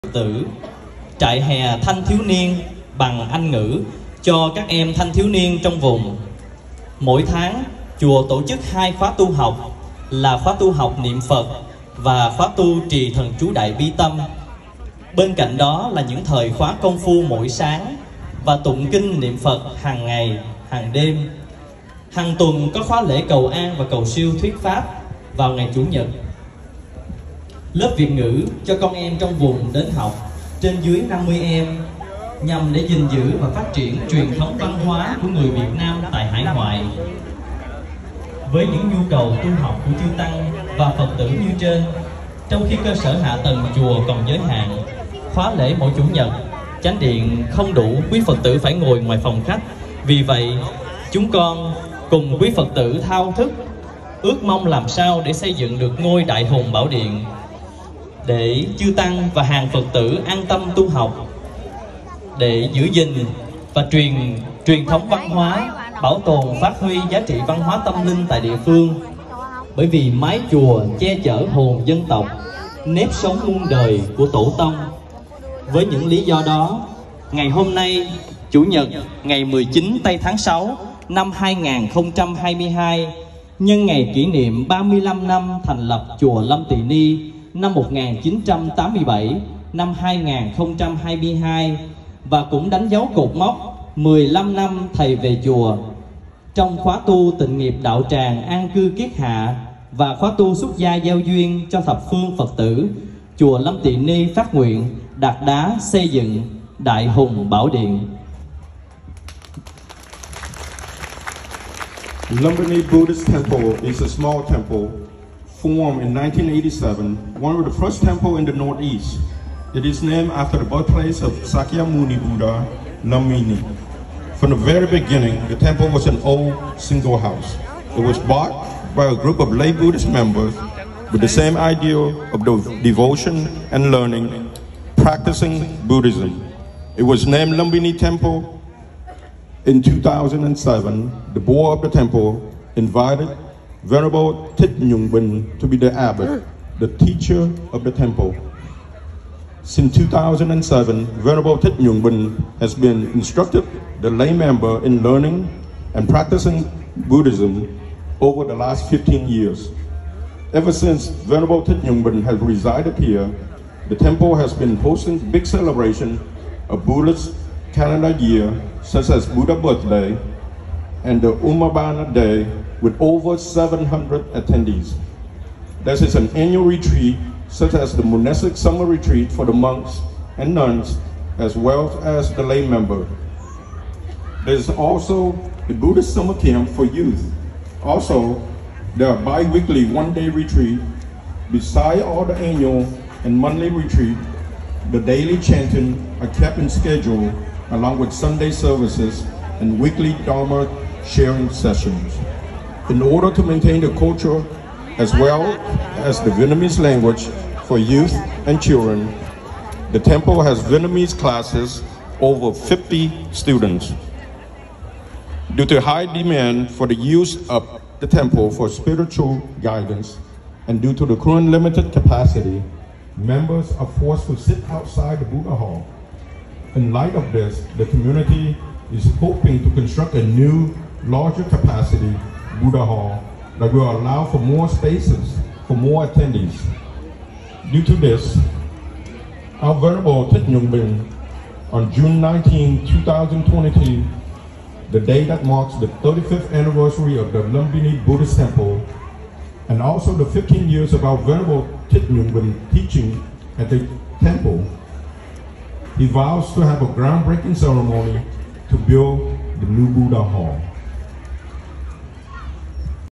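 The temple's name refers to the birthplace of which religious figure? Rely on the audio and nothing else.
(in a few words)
Sakyamuni Buddha.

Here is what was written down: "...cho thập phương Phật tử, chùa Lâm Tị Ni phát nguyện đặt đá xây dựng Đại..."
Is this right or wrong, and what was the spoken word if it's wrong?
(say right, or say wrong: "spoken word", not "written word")
right.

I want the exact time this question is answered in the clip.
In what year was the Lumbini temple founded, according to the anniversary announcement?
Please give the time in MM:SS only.
01:27.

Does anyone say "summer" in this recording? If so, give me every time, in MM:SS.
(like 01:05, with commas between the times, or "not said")
02:58, 03:06.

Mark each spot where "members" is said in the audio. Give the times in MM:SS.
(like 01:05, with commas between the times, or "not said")
02:10, 02:34, 03:02, 03:43.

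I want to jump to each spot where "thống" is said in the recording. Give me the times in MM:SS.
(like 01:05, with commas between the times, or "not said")
00:34, 01:04.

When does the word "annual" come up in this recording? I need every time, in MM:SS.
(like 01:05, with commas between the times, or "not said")
02:56, 03:12.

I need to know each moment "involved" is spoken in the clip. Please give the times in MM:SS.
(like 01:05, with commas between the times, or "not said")
not said.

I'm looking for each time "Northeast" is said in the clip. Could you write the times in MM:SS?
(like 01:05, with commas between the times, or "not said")
01:58.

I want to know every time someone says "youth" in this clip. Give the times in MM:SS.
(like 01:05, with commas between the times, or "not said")
03:06, 03:27.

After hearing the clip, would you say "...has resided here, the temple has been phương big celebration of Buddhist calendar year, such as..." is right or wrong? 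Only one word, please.
wrong.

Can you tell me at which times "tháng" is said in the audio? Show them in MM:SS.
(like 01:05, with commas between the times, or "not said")
00:07, 01:20.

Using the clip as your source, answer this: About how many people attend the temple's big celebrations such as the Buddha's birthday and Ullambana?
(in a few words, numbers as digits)
Over 700.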